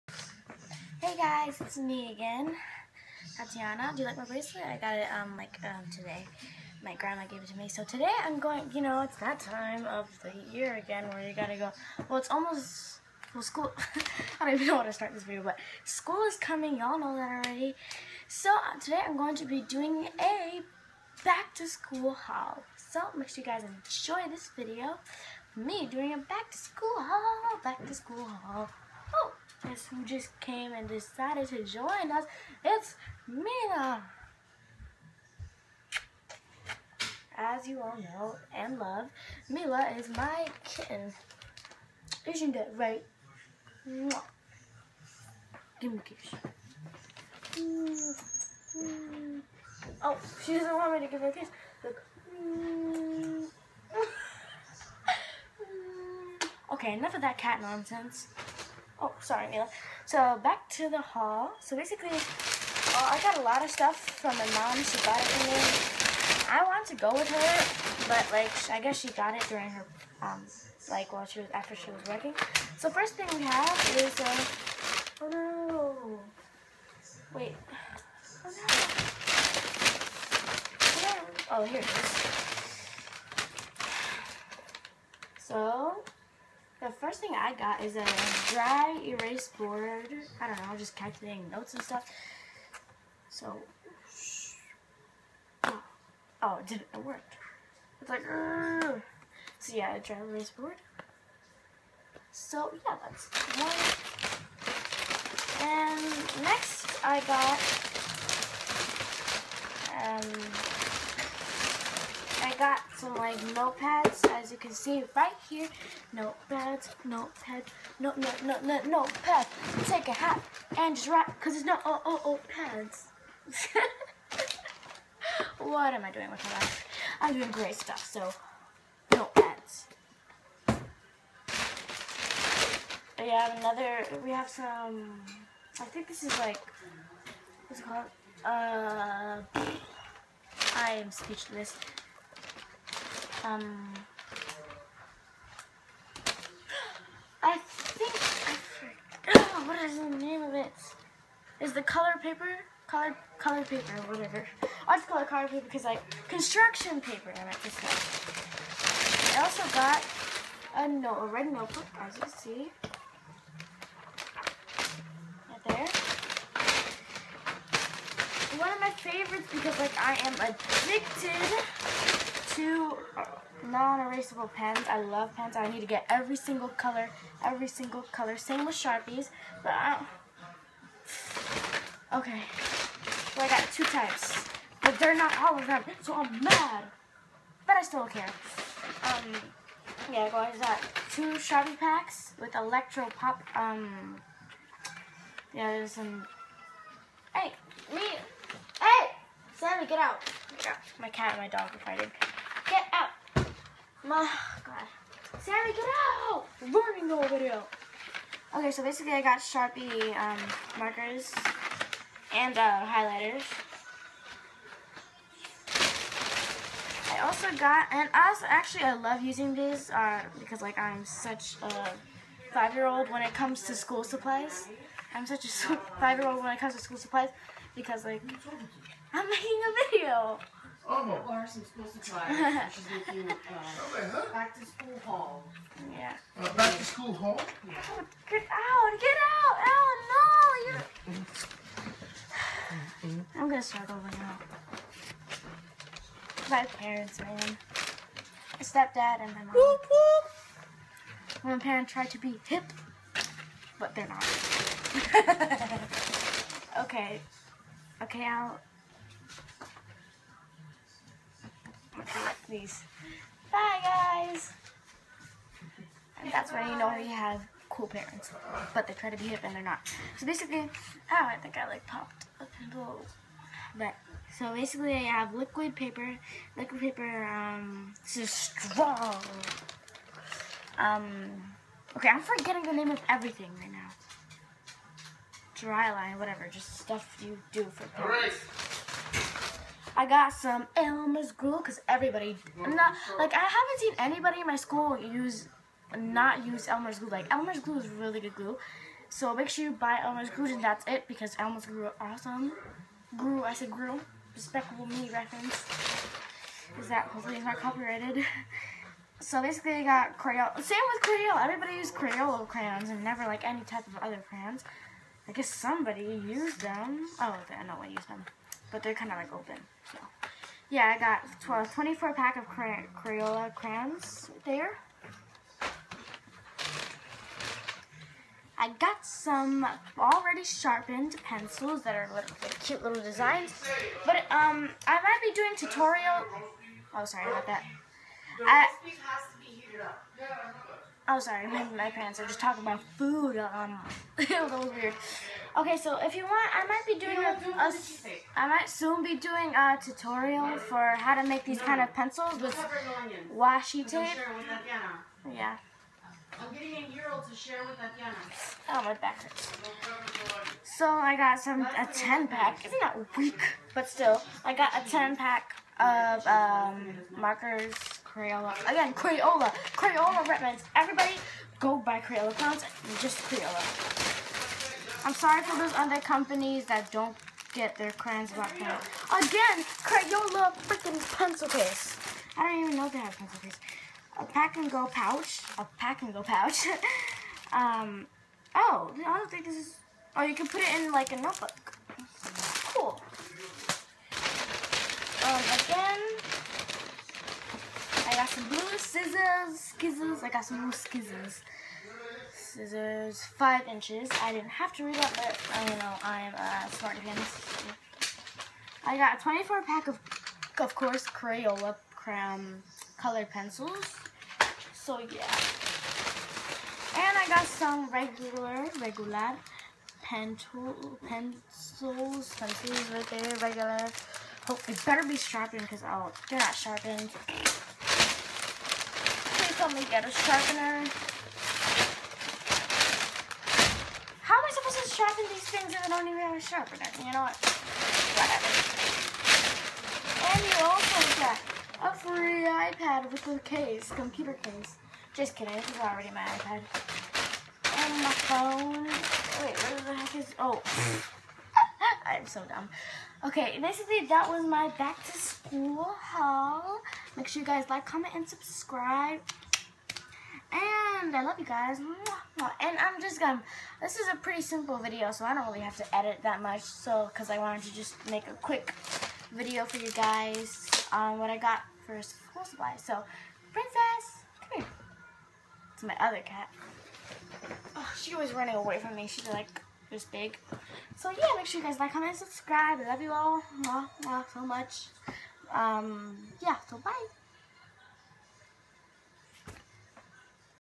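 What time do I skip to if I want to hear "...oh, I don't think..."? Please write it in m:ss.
6:28.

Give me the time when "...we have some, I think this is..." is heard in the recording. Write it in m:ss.
2:14.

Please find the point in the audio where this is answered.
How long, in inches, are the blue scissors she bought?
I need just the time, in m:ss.
6:43.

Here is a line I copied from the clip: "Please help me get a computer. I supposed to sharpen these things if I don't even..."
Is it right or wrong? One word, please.
wrong.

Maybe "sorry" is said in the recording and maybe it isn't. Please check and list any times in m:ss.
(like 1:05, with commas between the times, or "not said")
0:59, 5:37, 5:41, 6:15.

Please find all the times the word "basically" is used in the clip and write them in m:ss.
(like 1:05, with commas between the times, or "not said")
1:01, 3:28, 4:30, 4:34, 5:09, 7:33.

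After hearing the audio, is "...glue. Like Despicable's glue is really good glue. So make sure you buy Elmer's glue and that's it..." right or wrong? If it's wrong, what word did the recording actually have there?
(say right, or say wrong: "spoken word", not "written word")
wrong: "Elmer", not "Despicable".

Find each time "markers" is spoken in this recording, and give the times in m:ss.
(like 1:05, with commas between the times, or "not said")
3:30, 6:07.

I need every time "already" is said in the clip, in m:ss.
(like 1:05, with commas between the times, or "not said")
0:17, 5:29, 7:25.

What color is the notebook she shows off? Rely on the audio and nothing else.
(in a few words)
Red.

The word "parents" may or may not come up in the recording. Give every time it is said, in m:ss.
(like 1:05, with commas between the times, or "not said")
4:06, 4:11, 4:27, 4:47, 5:41.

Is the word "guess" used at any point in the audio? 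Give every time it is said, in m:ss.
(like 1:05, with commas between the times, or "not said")
1:08, 5:15.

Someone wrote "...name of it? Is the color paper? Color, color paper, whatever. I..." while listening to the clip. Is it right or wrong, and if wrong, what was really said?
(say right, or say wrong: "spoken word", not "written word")
right.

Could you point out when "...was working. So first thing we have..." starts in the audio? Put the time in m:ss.
1:11.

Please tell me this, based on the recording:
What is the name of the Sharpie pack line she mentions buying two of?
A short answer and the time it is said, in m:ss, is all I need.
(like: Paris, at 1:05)
Electro Pop, at 3:12.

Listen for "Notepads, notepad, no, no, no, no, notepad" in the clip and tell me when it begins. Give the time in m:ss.
1:56.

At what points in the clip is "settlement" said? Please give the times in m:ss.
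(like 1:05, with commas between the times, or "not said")
not said.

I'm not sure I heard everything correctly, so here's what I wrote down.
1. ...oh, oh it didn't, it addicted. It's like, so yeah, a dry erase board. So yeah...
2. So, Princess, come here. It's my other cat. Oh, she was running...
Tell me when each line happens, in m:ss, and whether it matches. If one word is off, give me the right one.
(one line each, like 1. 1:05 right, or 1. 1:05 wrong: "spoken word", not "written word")
1. 1:35 wrong: "worked", not "addicted"
2. 7:52 right.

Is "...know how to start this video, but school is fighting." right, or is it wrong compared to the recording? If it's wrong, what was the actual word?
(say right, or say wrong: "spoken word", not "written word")
wrong: "coming", not "fighting".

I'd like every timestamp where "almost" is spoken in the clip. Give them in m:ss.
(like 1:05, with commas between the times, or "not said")
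0:12.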